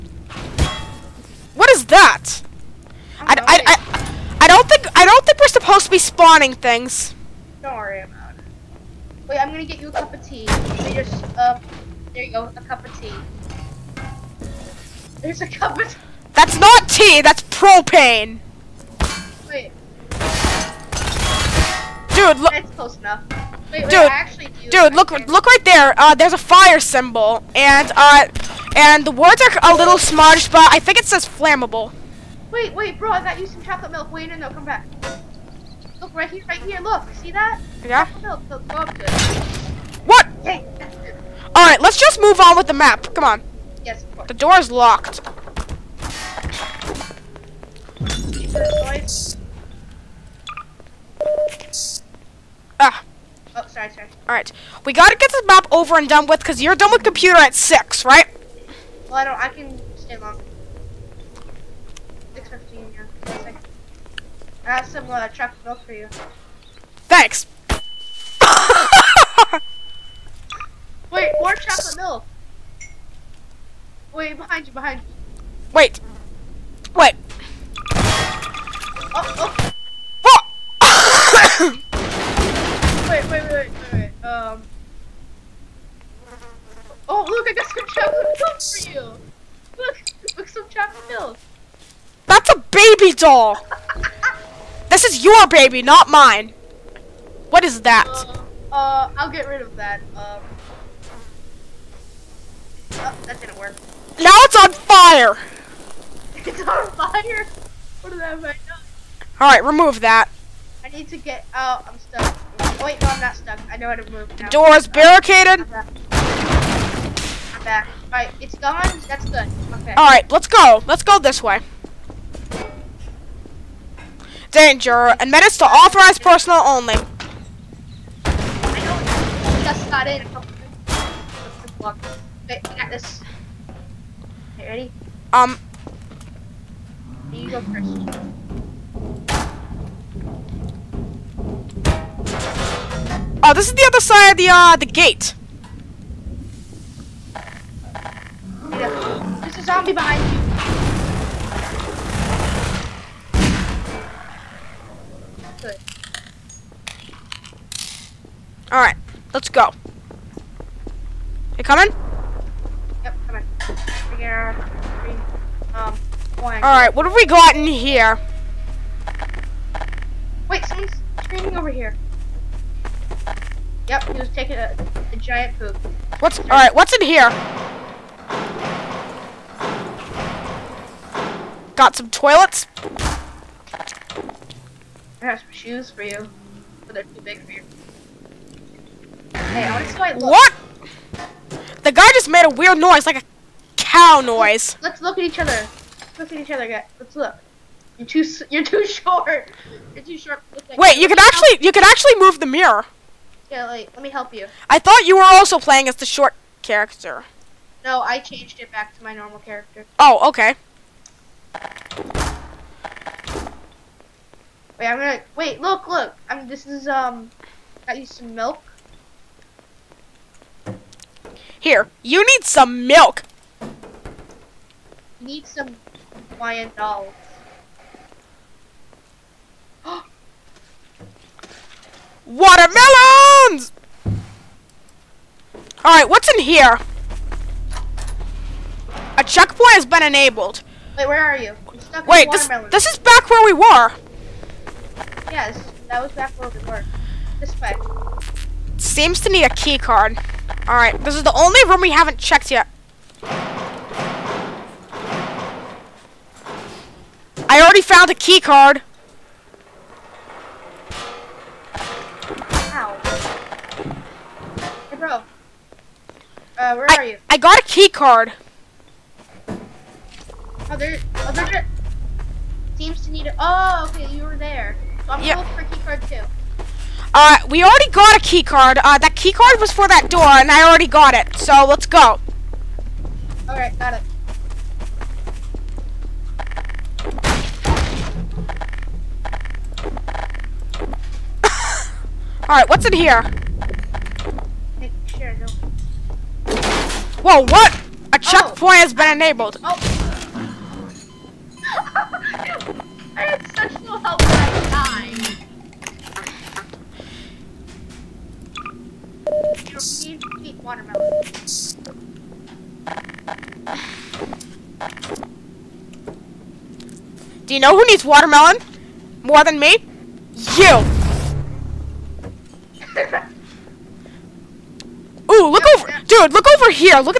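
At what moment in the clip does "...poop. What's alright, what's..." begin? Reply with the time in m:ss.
2:55.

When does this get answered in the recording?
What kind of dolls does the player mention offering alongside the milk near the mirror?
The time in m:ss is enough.
3:46.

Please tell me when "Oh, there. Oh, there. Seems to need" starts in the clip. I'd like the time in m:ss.
4:29.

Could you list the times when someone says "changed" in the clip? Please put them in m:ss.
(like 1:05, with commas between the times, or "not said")
3:28.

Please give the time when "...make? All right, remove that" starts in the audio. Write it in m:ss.
1:48.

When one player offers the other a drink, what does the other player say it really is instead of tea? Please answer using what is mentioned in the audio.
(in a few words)
Propane.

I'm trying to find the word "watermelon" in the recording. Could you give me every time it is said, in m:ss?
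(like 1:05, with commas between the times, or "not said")
3:52, 5:10, 5:18.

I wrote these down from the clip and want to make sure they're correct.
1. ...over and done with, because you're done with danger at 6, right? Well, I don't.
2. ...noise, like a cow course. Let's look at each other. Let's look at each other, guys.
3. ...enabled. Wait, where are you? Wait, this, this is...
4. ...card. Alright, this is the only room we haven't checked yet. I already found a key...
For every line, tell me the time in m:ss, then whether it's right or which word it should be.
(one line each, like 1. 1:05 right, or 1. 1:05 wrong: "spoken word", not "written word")
1. 0:55 wrong: "computer", not "danger"
2. 3:12 wrong: "noise", not "course"
3. 4:00 right
4. 4:09 right.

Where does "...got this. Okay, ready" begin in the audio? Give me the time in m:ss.
2:12.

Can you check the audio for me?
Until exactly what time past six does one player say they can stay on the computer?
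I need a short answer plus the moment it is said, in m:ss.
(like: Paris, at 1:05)
6:15, at 1:02.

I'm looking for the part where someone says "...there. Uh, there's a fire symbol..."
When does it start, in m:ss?
0:25.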